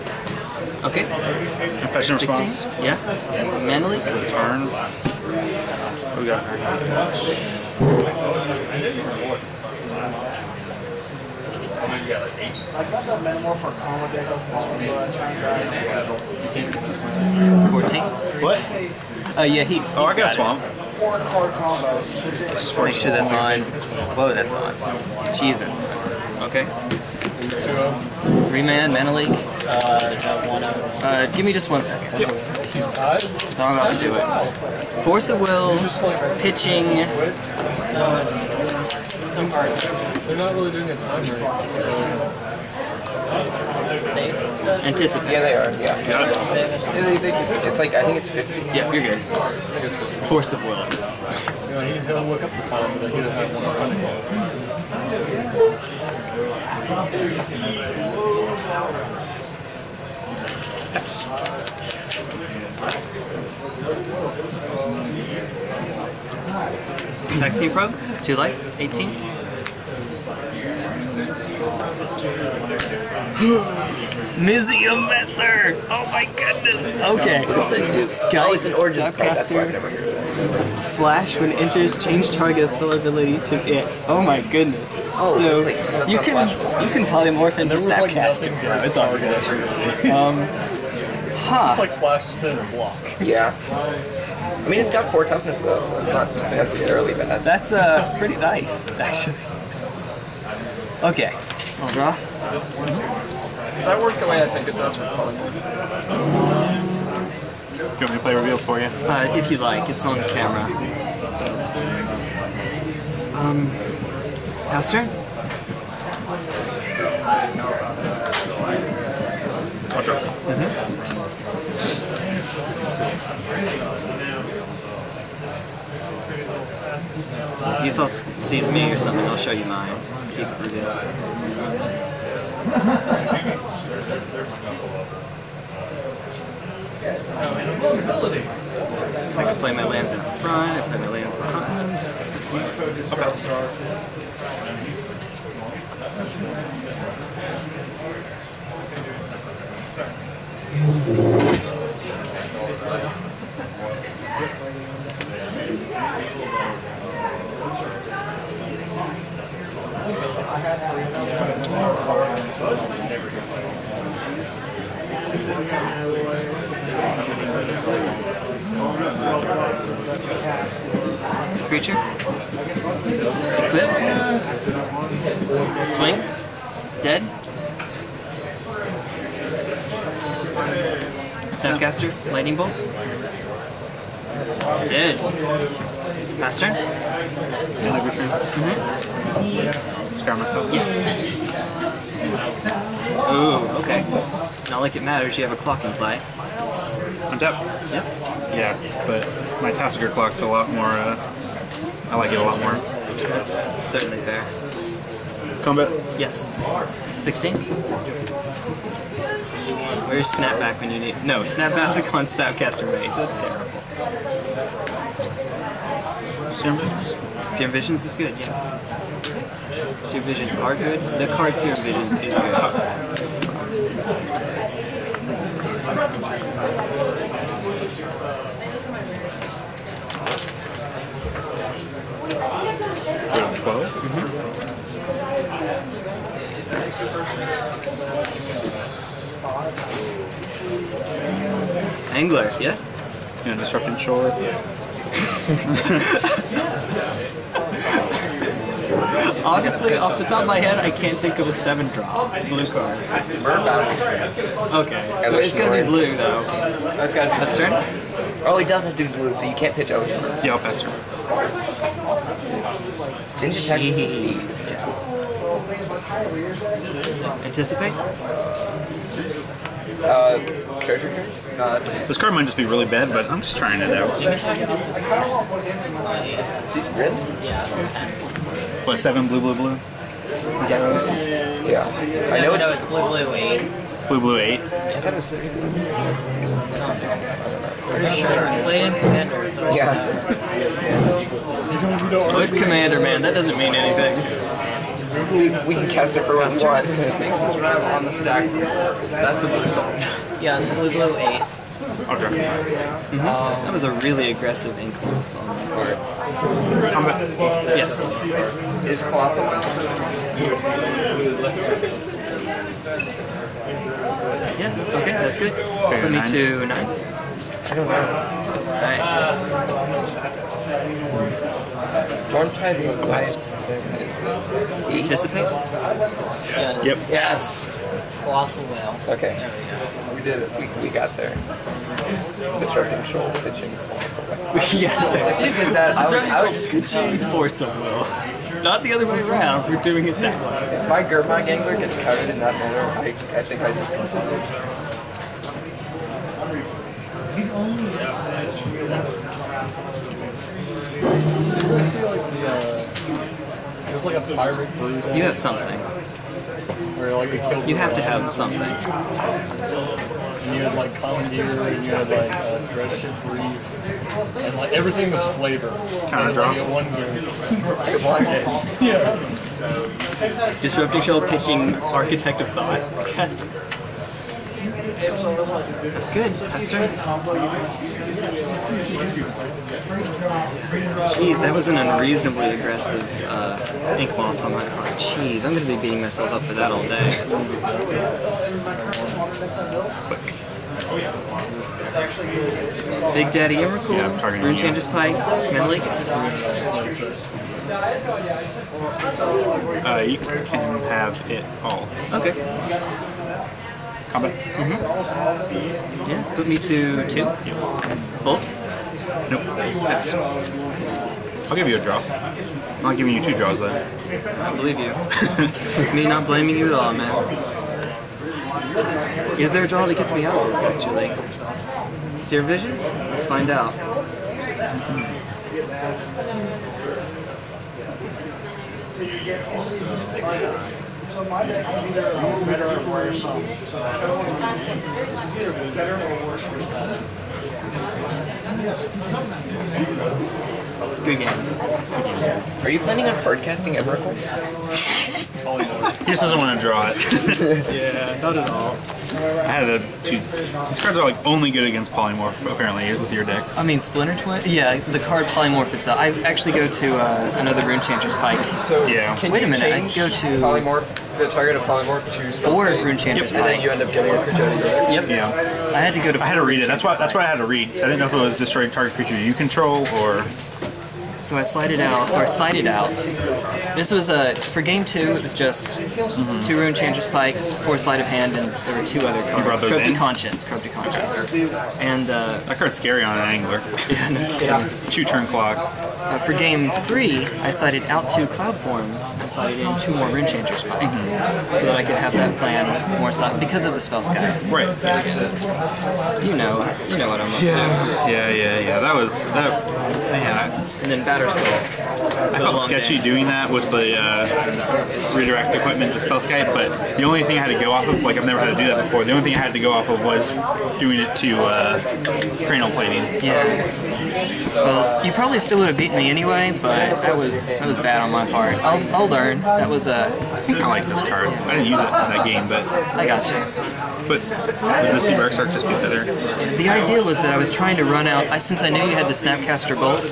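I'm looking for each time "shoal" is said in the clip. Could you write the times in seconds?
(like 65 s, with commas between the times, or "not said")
243 s, 333 s, 371 s.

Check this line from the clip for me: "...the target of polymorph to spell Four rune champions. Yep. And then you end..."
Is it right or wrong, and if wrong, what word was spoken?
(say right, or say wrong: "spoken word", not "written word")
right.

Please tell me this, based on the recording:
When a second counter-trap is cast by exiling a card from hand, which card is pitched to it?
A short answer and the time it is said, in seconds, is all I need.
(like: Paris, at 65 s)
Architect of Thought, at 371 s.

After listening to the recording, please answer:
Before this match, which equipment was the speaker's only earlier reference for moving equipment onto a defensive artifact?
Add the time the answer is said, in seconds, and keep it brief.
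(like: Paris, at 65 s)
Cranial Plating, at 512 s.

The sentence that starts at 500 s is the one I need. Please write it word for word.
Man, I, and then batter skull.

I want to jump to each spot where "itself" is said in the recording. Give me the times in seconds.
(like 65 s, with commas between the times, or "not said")
455 s.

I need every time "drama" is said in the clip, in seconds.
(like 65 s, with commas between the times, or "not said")
not said.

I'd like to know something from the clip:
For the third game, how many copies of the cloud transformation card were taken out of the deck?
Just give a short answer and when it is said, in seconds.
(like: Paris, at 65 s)
2, at 488 s.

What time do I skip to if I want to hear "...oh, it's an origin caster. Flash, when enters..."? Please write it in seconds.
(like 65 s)
78 s.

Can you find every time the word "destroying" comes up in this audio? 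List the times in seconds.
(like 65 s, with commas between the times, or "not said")
468 s.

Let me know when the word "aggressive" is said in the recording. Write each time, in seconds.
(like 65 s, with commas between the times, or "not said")
304 s, 382 s.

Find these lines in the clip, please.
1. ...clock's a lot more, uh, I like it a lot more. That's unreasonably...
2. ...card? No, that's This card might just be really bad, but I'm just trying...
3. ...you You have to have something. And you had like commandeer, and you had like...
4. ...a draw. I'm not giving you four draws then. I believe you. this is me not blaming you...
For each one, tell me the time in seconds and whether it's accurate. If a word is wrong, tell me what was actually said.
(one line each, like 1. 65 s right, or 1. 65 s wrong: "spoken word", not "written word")
1. 200 s wrong: "certainly", not "unreasonably"
2. 271 s right
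3. 357 s right
4. 411 s wrong: "two", not "four".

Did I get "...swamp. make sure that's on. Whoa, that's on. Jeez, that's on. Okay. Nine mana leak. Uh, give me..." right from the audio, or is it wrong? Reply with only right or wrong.
wrong.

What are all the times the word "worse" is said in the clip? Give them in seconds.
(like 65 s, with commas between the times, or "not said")
436 s.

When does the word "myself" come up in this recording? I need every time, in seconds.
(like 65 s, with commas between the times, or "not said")
190 s, 386 s.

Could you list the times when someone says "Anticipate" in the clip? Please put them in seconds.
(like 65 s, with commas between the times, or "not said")
44 s, 267 s, 325 s.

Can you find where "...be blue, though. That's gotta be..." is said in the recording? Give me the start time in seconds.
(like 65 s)
255 s.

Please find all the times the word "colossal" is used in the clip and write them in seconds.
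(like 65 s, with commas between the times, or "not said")
309 s, 328 s, 333 s.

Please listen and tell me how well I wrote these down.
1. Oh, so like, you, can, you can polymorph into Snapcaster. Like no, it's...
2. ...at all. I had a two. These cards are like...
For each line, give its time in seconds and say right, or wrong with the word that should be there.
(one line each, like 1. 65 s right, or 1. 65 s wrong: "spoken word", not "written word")
1. 85 s right
2. 448 s right.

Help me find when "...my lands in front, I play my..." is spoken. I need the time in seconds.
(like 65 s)
139 s.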